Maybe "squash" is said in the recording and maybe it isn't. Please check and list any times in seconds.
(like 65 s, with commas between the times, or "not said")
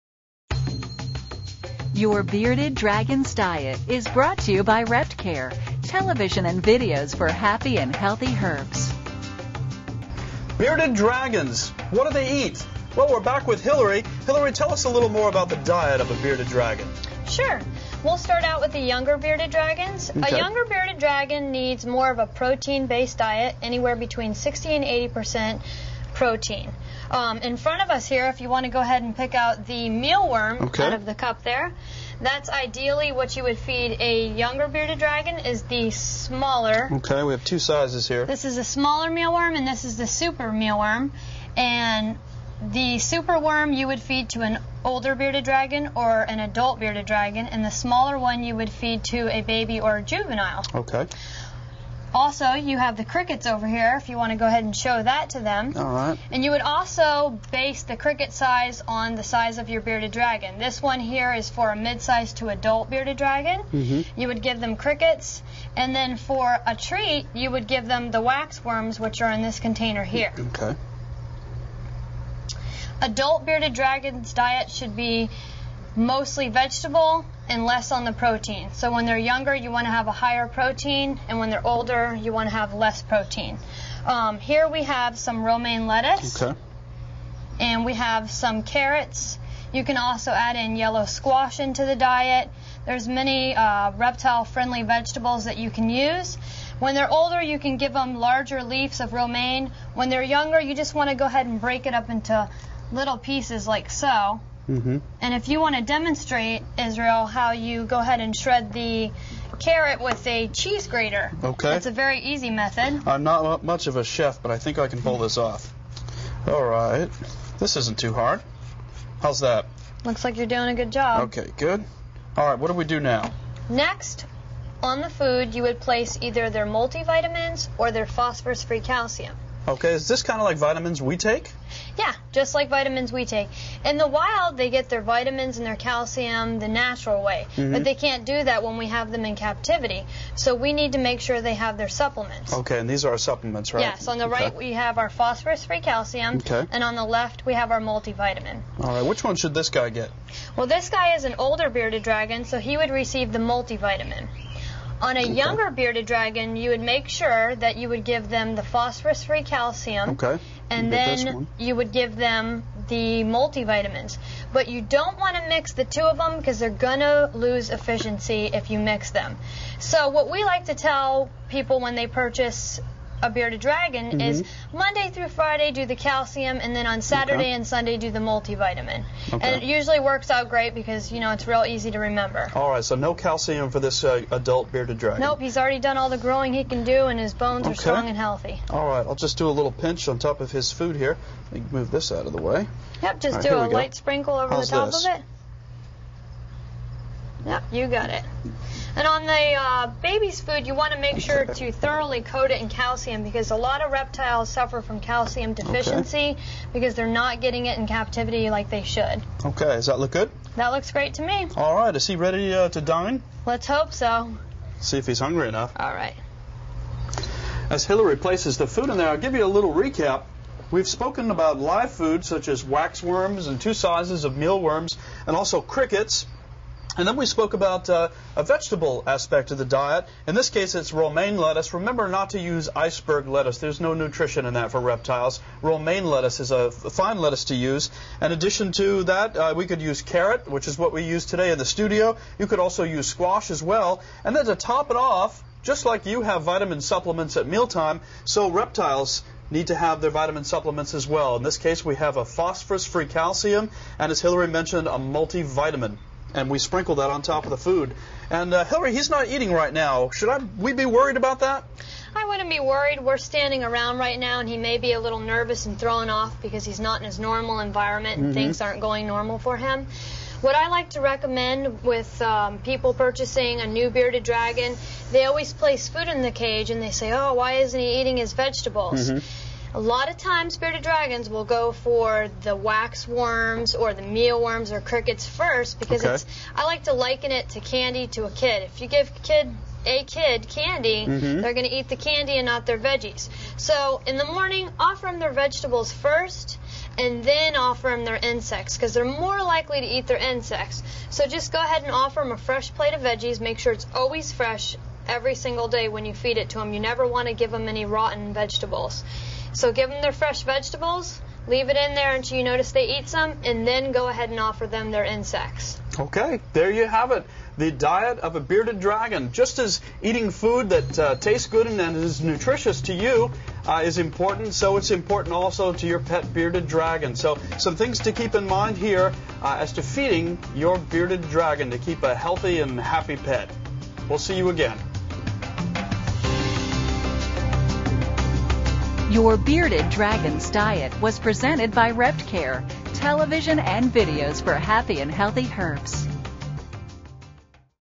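91 s, 243 s.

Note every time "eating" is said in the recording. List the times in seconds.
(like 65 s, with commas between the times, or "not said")
259 s, 278 s, 320 s.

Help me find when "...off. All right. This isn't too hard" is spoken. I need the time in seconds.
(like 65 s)
115 s.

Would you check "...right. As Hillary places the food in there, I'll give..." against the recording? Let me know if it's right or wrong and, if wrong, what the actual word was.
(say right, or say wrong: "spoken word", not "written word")
right.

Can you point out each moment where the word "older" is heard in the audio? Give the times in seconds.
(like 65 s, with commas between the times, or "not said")
44 s, 81 s, 97 s, 151 s.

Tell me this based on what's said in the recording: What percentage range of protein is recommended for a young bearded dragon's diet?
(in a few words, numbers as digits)
60 to 80 percent.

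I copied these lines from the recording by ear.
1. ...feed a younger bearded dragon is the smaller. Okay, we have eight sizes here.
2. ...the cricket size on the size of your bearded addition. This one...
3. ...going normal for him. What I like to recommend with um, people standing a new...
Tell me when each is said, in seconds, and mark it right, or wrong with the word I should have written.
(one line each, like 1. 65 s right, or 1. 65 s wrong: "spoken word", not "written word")
1. 33 s wrong: "two", not "eight"
2. 57 s wrong: "dragon", not "addition"
3. 268 s wrong: "purchasing", not "standing".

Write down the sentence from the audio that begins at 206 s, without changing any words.
because they're not getting it in captivity like they should.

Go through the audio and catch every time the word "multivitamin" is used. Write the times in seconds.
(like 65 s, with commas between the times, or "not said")
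126 s, 147 s, 153 s, 163 s, 178 s, 254 s.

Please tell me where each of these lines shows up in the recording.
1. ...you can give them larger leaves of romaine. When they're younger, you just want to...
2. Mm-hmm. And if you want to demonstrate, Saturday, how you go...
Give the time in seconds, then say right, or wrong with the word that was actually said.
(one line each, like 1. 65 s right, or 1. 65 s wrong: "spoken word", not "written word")
1. 97 s right
2. 104 s wrong: "Israel", not "Saturday".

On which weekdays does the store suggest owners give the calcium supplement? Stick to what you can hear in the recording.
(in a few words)
Monday through Friday.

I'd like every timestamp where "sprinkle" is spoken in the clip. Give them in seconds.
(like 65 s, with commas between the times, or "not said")
193 s, 256 s.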